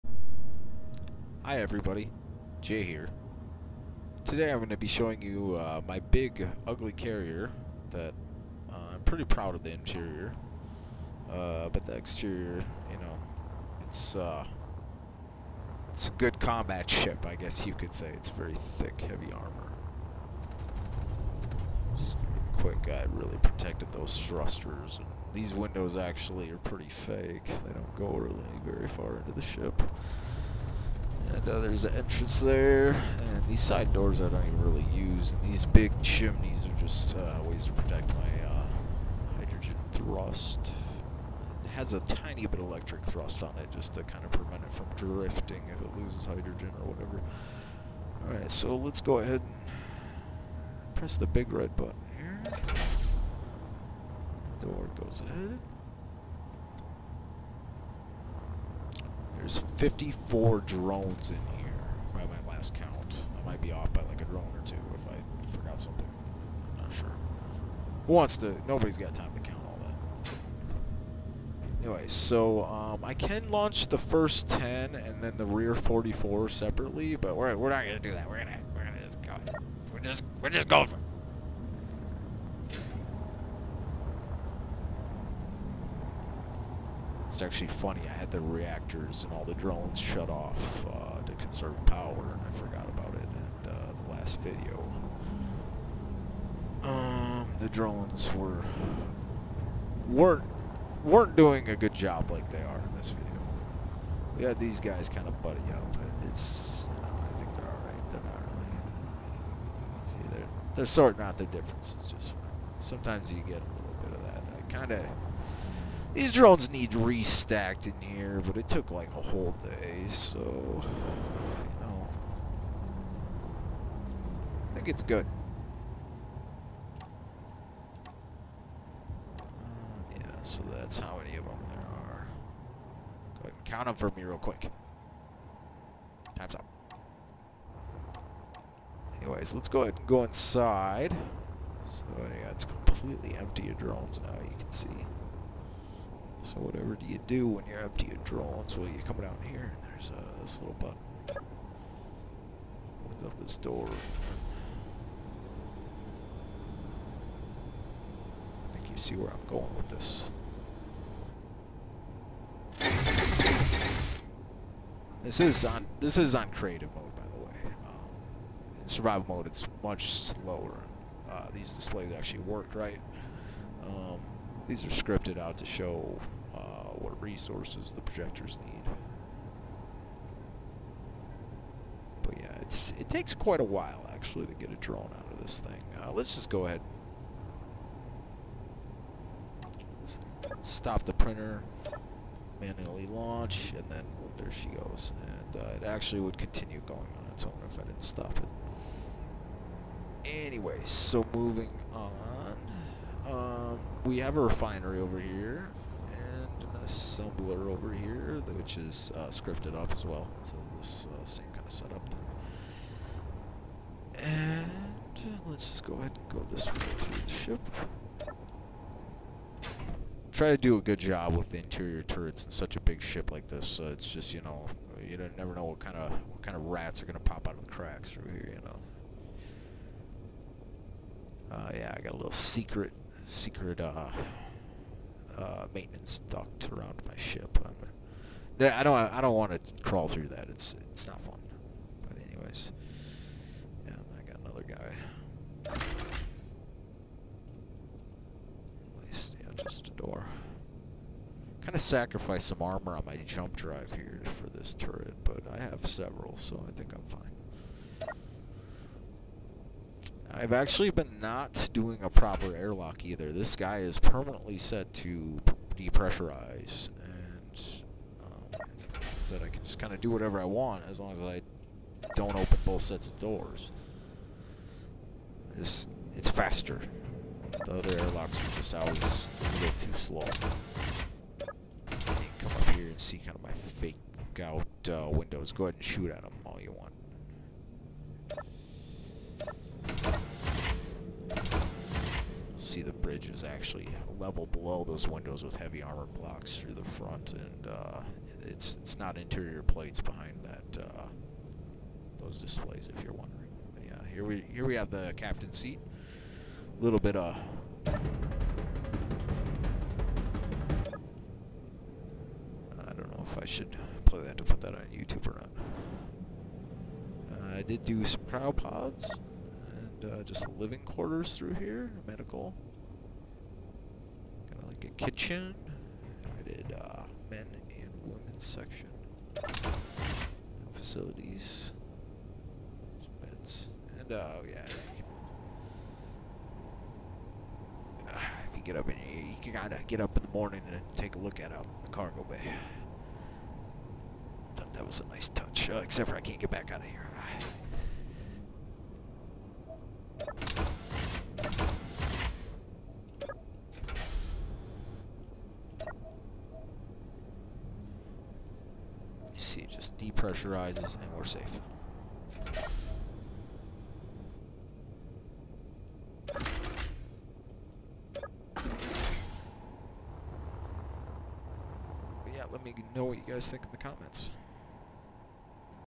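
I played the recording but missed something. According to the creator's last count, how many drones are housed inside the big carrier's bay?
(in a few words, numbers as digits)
54.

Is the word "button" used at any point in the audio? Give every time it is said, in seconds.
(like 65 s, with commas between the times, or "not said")
51 s, 150 s.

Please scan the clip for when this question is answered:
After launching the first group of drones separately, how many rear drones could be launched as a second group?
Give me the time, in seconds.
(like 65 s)
75 s.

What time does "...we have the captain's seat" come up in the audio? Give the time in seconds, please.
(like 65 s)
304 s.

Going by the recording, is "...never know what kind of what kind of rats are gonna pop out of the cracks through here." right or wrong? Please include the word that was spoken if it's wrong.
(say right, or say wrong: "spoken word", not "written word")
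right.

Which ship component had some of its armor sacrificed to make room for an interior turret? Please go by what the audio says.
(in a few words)
Jump drive.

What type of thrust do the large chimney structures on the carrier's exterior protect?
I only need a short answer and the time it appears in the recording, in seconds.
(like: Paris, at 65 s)
Hydrogen thrust, at 39 s.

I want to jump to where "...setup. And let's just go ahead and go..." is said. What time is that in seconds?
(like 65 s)
211 s.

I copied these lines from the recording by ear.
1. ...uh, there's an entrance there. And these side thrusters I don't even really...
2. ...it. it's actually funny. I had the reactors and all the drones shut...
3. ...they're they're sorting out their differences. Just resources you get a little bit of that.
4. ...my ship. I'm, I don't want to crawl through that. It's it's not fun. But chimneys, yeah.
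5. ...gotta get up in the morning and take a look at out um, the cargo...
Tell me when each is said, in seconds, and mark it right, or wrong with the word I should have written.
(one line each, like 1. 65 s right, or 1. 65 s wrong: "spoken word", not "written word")
1. 31 s wrong: "doors", not "thrusters"
2. 80 s right
3. 110 s wrong: "sometimes", not "resources"
4. 237 s wrong: "anyways", not "chimneys"
5. 339 s right.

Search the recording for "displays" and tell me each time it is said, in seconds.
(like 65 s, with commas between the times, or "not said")
171 s, 302 s.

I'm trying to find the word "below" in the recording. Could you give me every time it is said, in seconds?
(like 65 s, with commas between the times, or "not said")
294 s.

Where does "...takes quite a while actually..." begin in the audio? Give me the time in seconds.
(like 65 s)
183 s.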